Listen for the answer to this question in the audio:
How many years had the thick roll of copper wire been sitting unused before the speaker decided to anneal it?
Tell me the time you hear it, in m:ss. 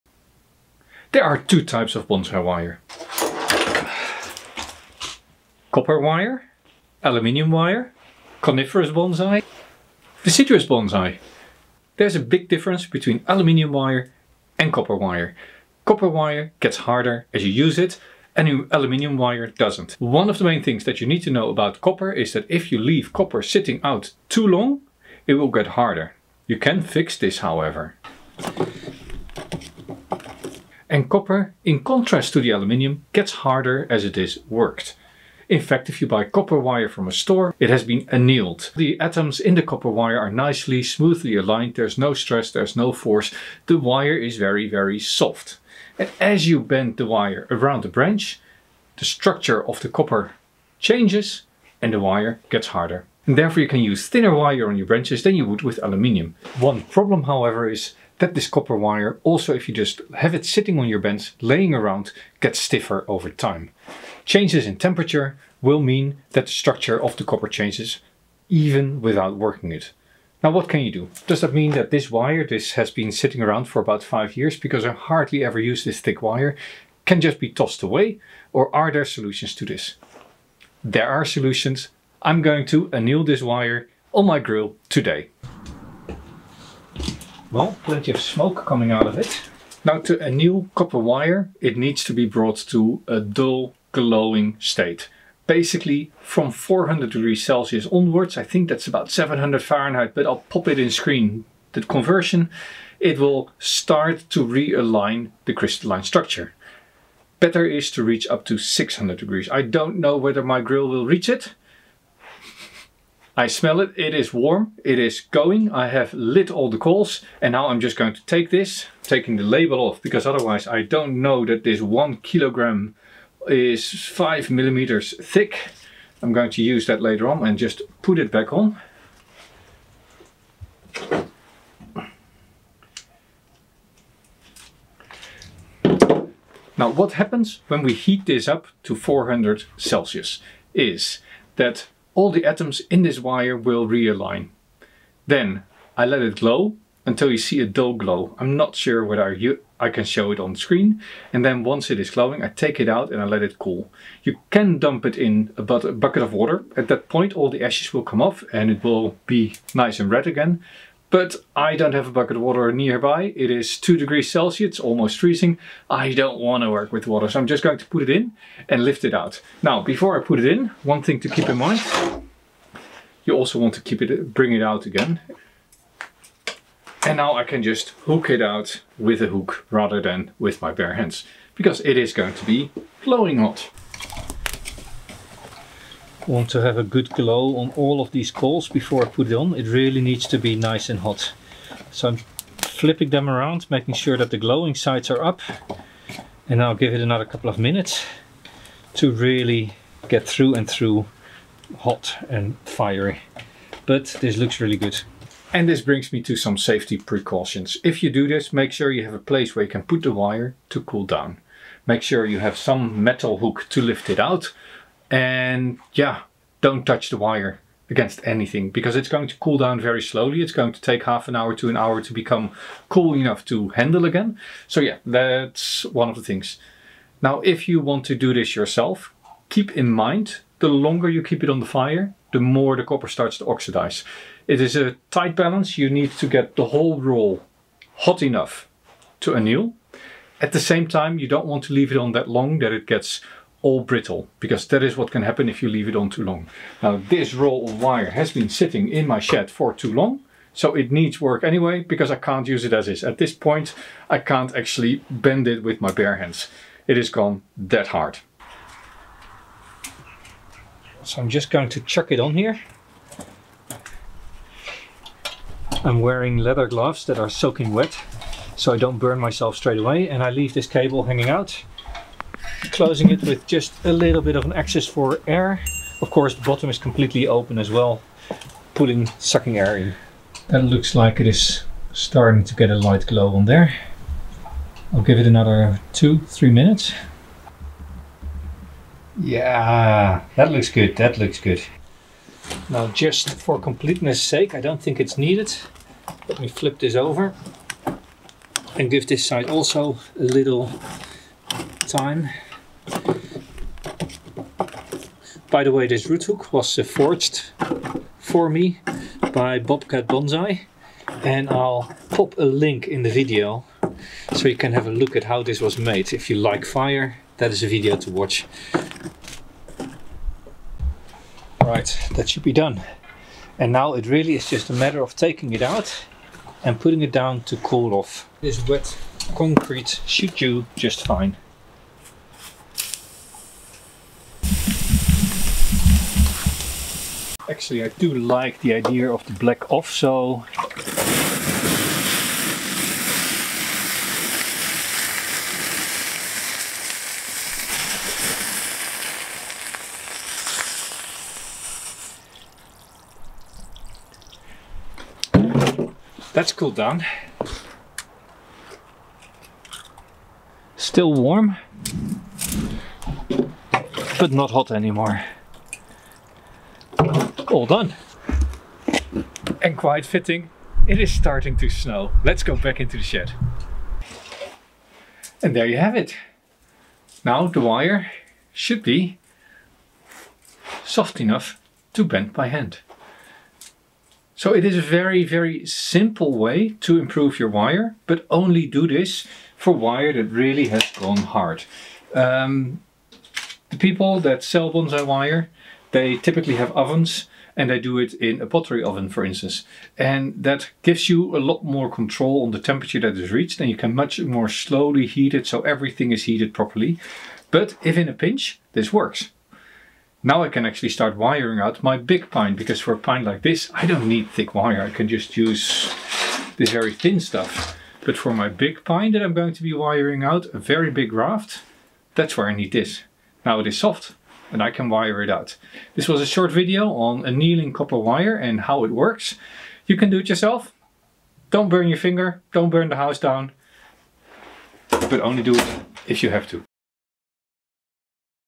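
1:13.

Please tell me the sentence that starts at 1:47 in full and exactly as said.
Better is to reach up to 600 degrees.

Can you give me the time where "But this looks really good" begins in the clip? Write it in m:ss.
3:23.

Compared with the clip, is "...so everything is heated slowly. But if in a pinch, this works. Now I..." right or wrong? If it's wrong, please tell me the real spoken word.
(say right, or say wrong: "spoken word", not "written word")
wrong: "properly", not "slowly".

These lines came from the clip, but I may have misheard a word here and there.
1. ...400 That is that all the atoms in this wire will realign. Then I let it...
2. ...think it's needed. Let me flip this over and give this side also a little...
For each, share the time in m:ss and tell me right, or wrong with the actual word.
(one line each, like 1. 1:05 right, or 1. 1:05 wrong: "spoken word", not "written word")
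1. 2:18 wrong: "Celsius", not "That"
2. 4:54 right.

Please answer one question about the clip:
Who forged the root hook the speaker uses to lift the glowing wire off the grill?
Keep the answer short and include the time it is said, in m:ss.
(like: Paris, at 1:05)
Bobcat Bonsai, at 5:09.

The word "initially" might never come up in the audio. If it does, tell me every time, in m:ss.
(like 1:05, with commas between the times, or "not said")
not said.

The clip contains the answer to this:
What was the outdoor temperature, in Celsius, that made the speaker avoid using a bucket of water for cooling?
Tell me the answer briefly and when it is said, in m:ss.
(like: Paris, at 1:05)
2 degrees, at 2:43.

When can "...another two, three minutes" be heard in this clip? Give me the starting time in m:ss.
4:45.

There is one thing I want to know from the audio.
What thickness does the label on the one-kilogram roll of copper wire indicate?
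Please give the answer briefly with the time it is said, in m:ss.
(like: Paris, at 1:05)
5 millimeters, at 2:04.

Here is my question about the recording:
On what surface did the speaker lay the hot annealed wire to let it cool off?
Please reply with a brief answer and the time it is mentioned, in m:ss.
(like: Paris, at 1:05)
Wet concrete, at 5:28.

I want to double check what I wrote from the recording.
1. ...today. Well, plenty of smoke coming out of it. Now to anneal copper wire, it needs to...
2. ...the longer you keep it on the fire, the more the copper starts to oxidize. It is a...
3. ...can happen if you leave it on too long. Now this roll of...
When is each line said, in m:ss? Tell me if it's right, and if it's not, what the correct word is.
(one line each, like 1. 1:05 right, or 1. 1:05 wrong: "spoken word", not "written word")
1. 1:24 right
2. 3:50 right
3. 4:05 right.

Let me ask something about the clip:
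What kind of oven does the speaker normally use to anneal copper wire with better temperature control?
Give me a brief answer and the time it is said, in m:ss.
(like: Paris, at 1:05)
Pottery oven, at 6:38.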